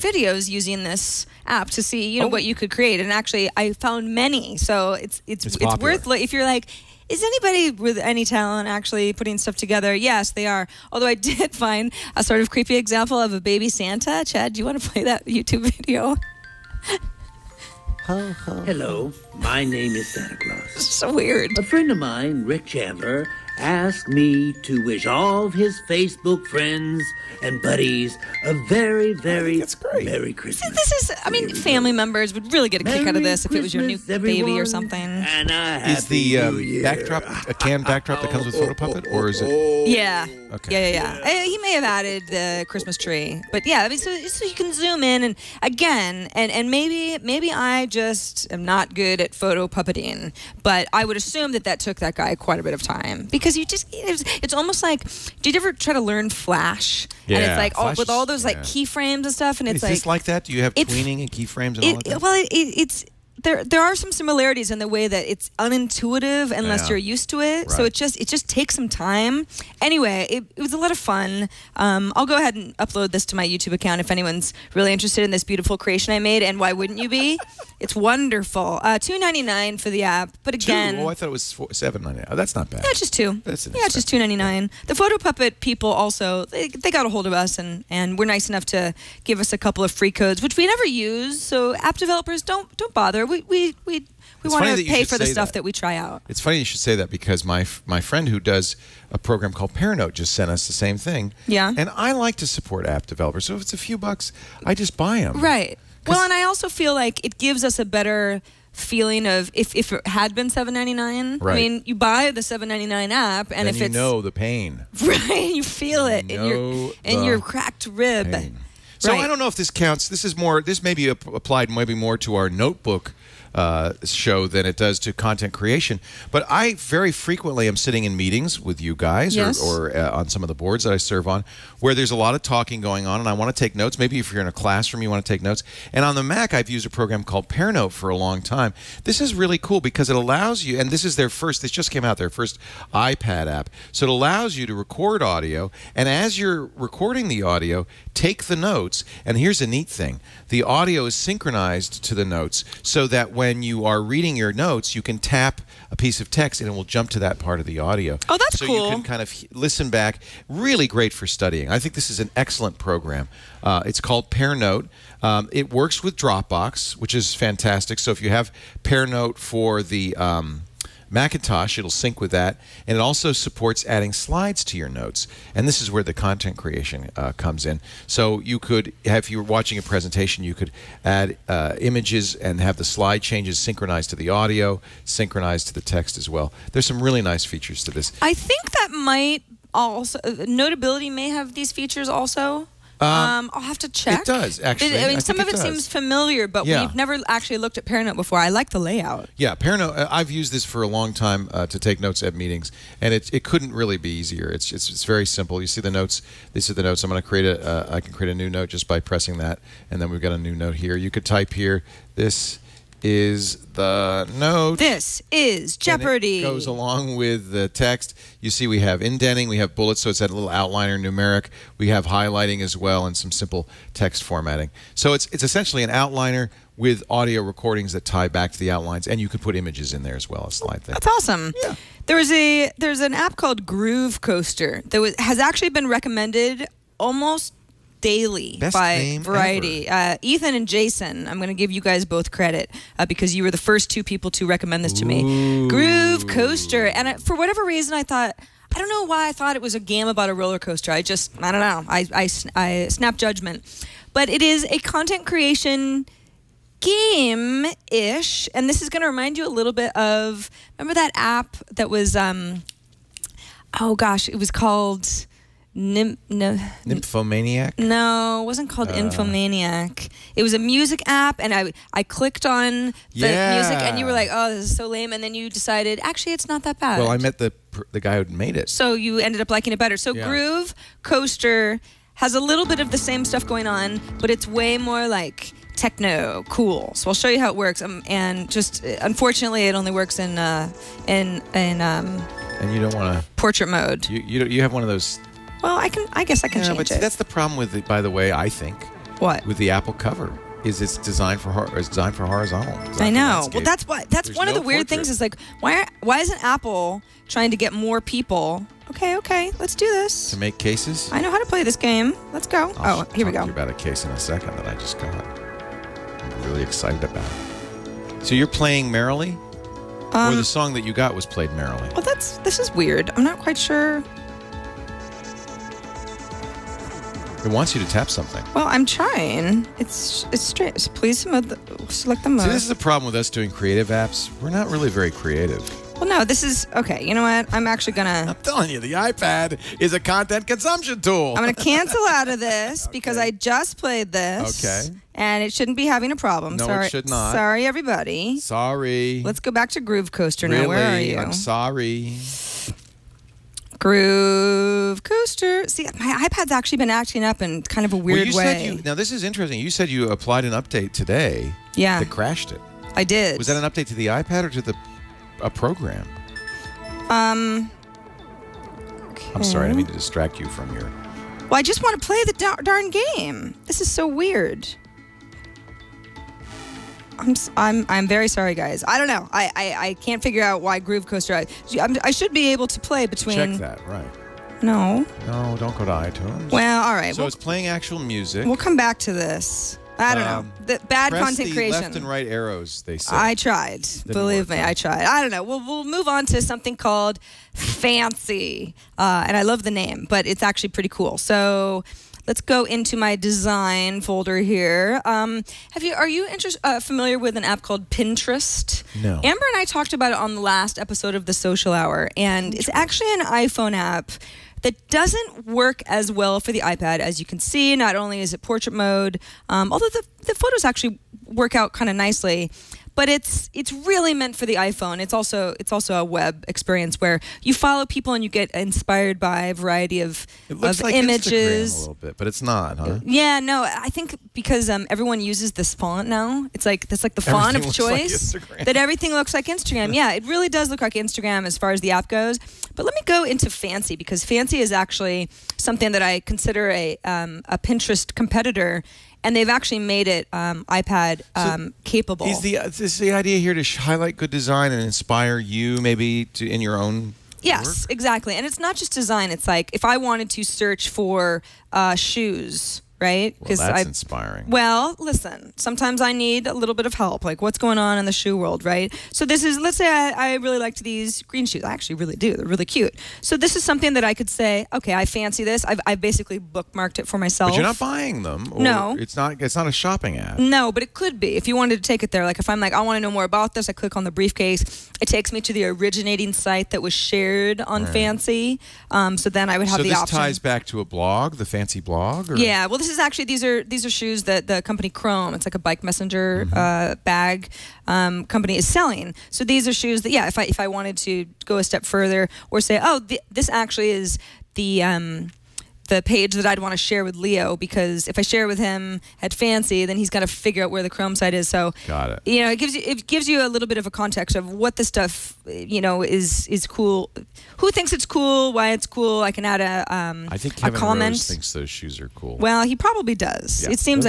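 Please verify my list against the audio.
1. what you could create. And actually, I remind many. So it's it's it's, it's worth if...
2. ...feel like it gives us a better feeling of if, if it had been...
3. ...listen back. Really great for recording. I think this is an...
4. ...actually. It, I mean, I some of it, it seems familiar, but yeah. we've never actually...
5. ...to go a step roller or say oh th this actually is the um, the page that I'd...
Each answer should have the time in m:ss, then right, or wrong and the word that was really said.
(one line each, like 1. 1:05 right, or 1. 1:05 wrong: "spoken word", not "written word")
1. 0:02 wrong: "found", not "remind"
2. 1:46 right
3. 2:39 wrong: "studying", not "recording"
4. 3:14 right
5. 8:21 wrong: "further", not "roller".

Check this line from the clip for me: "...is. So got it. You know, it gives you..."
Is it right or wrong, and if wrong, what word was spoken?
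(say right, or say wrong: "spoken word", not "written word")
right.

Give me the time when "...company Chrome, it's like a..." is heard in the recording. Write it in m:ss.
8:14.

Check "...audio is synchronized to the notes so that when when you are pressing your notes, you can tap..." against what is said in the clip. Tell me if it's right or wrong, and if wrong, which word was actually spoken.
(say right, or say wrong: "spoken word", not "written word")
wrong: "reading", not "pressing".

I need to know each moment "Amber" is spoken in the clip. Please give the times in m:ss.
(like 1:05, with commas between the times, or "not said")
6:49.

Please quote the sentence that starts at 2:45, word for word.
Um, it works with Dropbox, which is fantastic.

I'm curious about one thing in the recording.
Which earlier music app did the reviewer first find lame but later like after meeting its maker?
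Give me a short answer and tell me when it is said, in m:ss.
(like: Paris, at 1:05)
Infomaniac, at 4:28.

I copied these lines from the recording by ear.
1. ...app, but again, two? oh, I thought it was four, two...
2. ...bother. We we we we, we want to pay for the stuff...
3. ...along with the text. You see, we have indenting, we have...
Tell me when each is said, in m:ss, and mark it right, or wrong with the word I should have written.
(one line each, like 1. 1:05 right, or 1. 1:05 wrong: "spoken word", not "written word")
1. 1:20 wrong: "seven", not "two"
2. 1:32 right
3. 3:36 right.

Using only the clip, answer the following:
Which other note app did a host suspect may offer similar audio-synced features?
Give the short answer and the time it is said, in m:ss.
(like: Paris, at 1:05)
Notability, at 3:10.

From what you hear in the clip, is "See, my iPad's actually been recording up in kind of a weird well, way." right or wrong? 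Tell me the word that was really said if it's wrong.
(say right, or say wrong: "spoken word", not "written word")
wrong: "acting", not "recording".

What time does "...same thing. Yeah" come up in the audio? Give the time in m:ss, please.
1:40.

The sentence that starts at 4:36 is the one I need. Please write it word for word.
Well, I met the the guy who made it, so you ended up liking it better.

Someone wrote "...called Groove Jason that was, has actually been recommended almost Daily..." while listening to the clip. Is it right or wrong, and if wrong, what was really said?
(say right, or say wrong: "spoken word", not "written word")
wrong: "Coaster", not "Jason".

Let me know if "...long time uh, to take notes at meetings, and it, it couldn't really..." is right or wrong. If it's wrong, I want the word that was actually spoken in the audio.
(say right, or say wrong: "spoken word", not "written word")
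right.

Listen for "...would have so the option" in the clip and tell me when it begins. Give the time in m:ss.
8:09.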